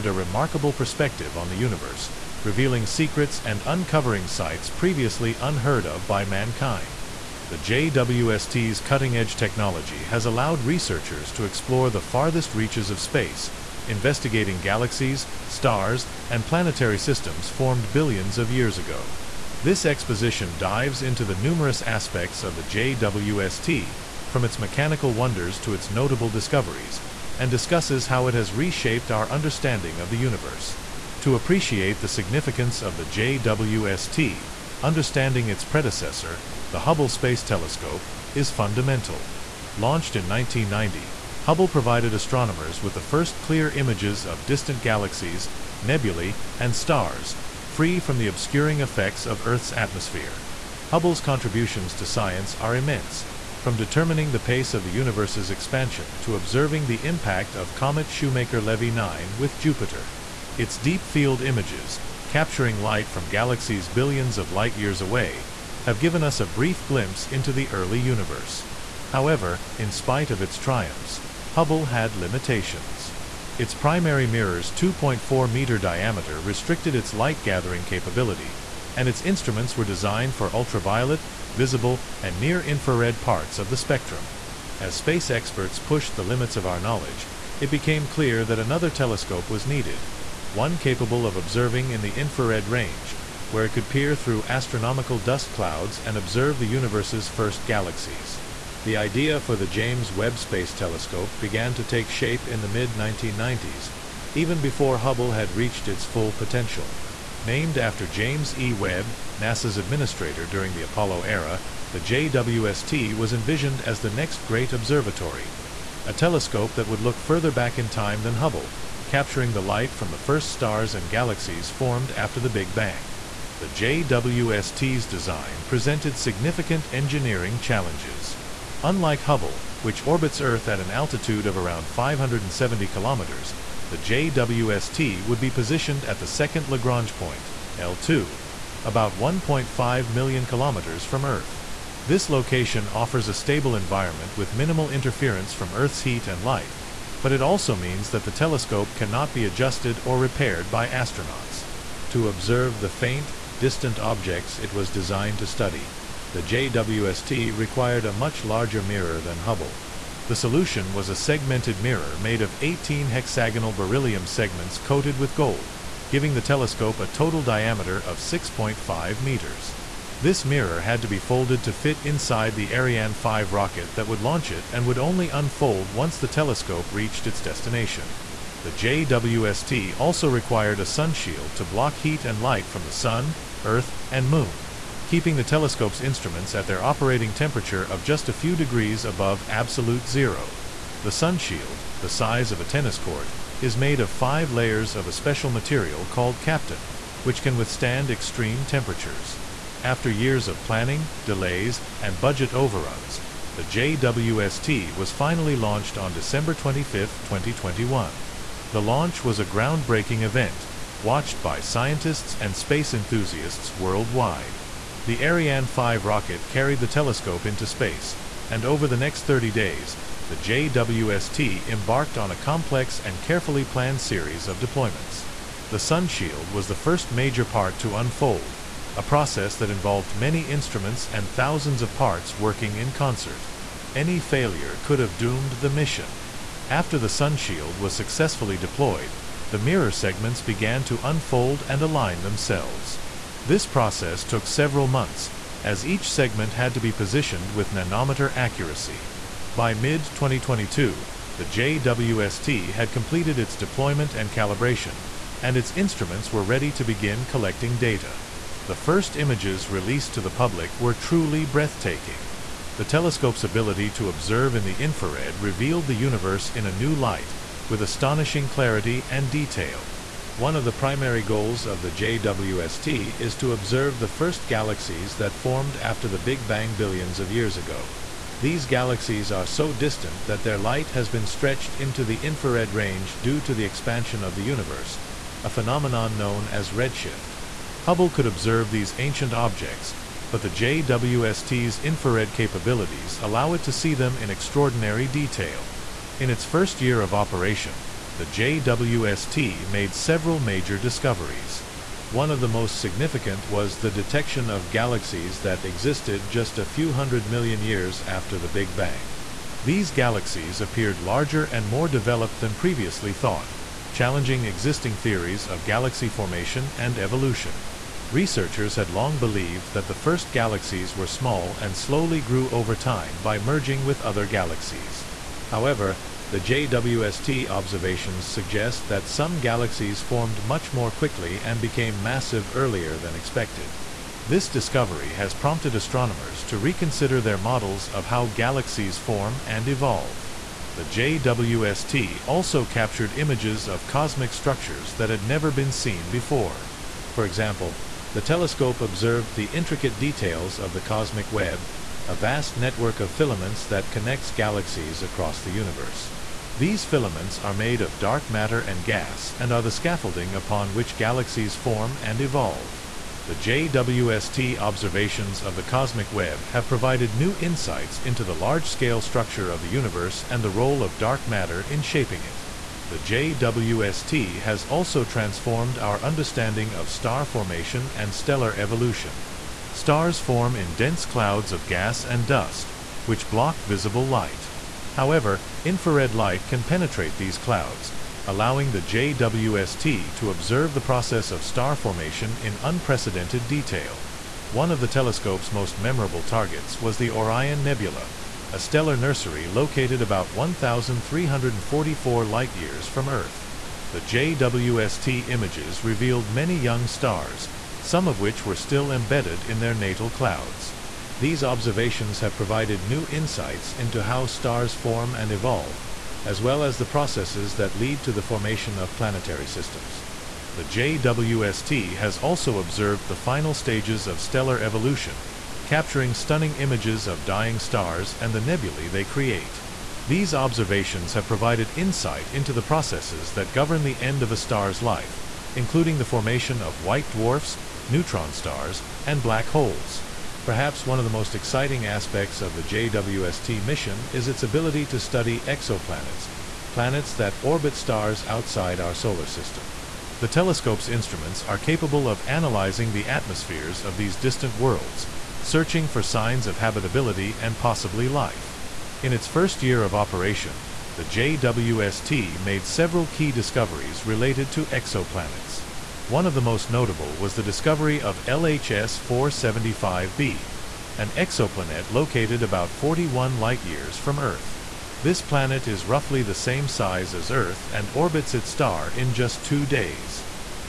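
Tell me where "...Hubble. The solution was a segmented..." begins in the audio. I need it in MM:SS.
02:39.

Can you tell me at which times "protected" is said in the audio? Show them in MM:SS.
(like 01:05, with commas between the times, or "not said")
not said.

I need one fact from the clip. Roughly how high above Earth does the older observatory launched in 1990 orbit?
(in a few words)
570 kilometers.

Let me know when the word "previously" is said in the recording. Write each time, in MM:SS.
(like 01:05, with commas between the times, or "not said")
00:04, 05:12.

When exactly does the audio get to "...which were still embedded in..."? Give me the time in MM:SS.
06:48.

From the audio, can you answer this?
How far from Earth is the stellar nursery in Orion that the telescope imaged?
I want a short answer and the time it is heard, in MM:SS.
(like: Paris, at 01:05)
1,344 light-years, at 06:40.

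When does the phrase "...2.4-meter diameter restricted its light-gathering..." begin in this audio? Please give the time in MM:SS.
01:14.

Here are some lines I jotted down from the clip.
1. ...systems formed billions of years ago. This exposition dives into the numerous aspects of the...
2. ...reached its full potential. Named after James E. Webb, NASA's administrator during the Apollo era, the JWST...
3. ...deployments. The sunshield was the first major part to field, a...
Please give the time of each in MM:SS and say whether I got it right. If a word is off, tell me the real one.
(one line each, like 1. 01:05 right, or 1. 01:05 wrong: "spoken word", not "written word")
1. 00:16 right
2. 01:45 right
3. 03:44 wrong: "unfold", not "field".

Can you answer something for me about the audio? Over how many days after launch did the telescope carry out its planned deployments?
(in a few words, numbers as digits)
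30.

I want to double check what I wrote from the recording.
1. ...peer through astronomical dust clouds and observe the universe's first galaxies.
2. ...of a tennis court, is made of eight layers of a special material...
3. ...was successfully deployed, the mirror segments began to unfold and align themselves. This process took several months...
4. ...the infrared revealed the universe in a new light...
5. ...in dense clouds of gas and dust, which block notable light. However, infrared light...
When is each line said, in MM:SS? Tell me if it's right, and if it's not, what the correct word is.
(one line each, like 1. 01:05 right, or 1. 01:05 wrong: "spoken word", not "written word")
1. 01:33 right
2. 03:12 wrong: "five", not "eight"
3. 03:57 right
4. 04:24 right
5. 06:20 wrong: "visible", not "notable".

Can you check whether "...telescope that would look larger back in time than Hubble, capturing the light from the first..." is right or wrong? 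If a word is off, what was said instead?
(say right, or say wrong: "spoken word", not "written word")
wrong: "further", not "larger".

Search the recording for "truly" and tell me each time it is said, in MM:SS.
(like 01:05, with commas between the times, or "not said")
04:20.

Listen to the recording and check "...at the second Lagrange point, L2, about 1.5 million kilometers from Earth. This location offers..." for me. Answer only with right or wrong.
right.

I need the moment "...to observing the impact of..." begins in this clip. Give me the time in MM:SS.
00:56.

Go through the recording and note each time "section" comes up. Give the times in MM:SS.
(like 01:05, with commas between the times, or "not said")
not said.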